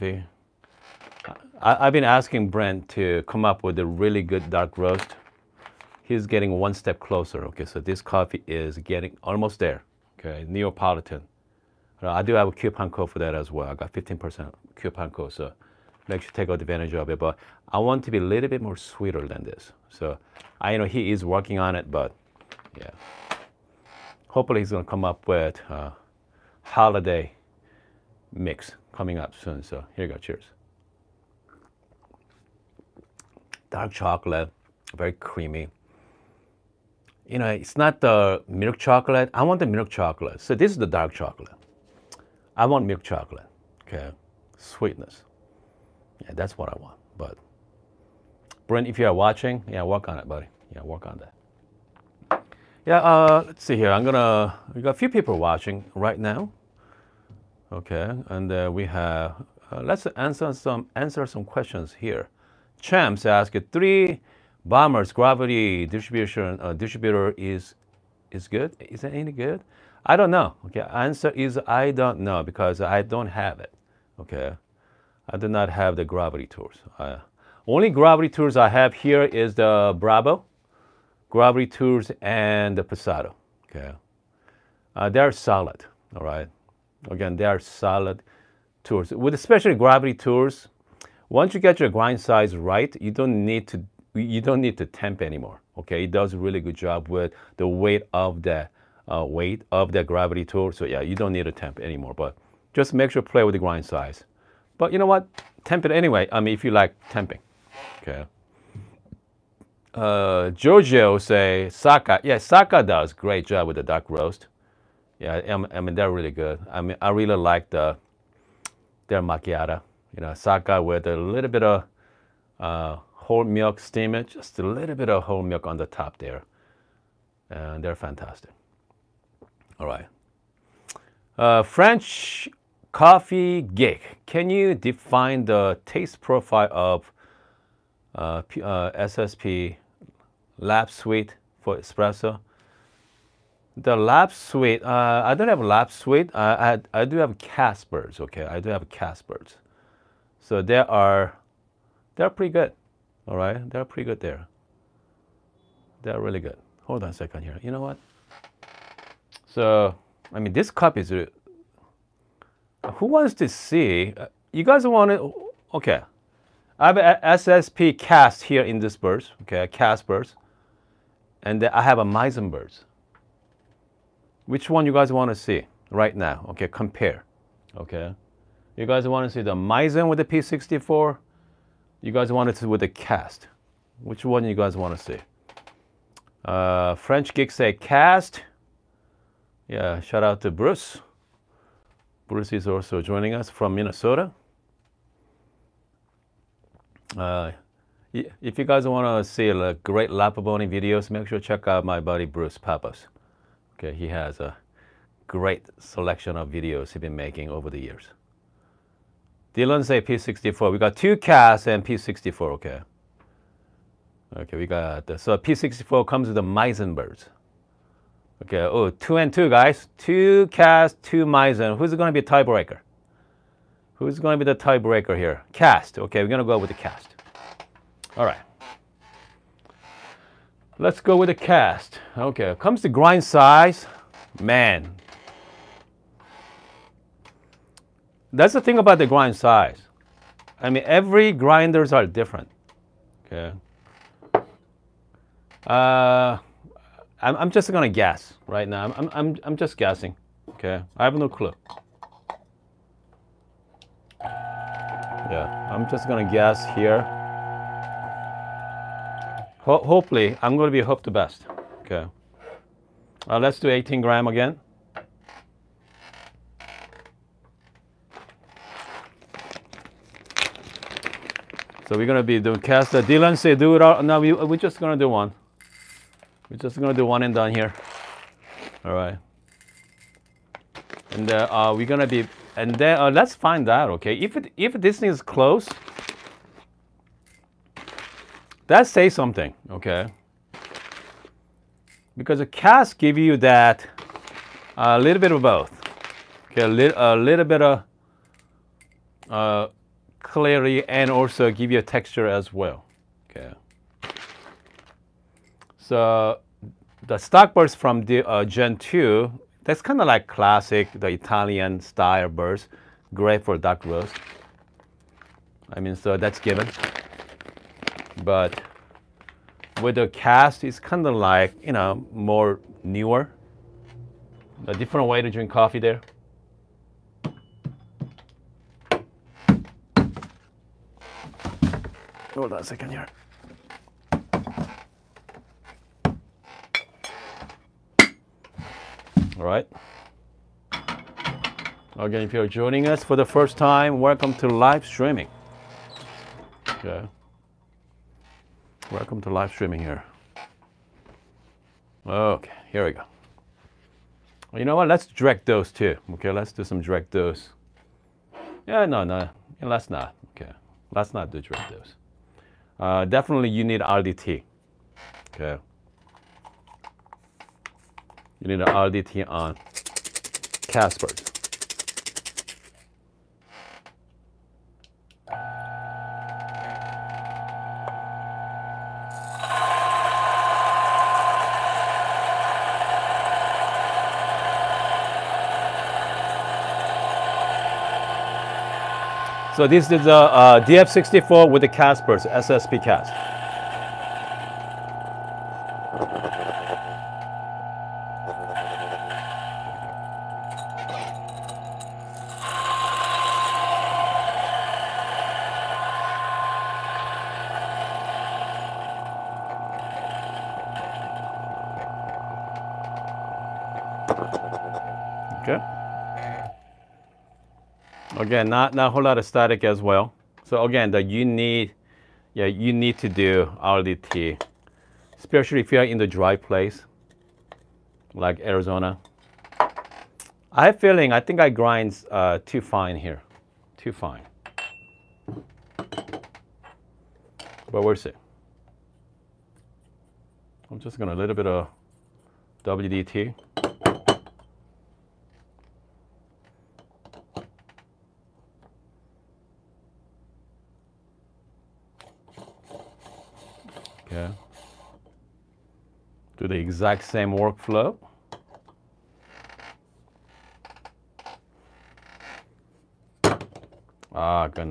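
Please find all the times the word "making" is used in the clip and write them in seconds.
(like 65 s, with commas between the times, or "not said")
207 s.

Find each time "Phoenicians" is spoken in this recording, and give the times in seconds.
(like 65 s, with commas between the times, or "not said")
not said.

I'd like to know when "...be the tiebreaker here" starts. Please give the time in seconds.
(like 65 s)
224 s.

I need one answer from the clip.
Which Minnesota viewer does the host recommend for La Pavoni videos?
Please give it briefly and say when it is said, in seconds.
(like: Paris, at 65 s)
Bruce Pappas, at 202 s.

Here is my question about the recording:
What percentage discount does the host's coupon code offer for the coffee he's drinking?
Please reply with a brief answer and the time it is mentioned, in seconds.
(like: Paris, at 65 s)
15%, at 13 s.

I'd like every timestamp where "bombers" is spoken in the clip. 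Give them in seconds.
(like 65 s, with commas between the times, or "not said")
64 s.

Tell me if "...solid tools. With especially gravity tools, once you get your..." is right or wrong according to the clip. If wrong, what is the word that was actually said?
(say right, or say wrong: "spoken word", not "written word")
right.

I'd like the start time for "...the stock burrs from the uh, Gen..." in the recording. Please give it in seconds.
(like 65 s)
307 s.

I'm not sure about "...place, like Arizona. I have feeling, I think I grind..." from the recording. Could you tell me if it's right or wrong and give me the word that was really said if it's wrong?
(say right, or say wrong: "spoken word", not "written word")
right.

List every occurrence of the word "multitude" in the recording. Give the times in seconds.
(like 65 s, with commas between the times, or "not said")
not said.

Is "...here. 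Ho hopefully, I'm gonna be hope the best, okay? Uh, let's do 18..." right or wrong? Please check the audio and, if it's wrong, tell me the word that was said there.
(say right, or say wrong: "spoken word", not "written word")
right.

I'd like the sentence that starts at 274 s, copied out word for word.
No, we, we're just gonna do one.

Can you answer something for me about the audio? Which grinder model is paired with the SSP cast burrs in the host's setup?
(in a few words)
DF64.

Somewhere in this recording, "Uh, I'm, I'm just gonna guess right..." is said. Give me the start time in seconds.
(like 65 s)
245 s.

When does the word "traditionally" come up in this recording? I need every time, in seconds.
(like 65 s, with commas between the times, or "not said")
not said.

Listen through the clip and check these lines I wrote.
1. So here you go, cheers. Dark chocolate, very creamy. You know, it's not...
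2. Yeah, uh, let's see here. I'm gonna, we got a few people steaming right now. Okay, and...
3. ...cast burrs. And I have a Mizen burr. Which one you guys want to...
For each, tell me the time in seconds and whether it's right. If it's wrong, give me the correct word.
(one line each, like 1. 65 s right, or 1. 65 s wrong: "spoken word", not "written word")
1. 29 s right
2. 52 s wrong: "watching", not "steaming"
3. 169 s right.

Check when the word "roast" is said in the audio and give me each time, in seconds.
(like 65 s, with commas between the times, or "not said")
4 s, 114 s, 313 s.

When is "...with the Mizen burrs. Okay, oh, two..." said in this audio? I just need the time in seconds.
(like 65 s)
216 s.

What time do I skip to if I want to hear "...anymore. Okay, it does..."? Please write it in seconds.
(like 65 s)
95 s.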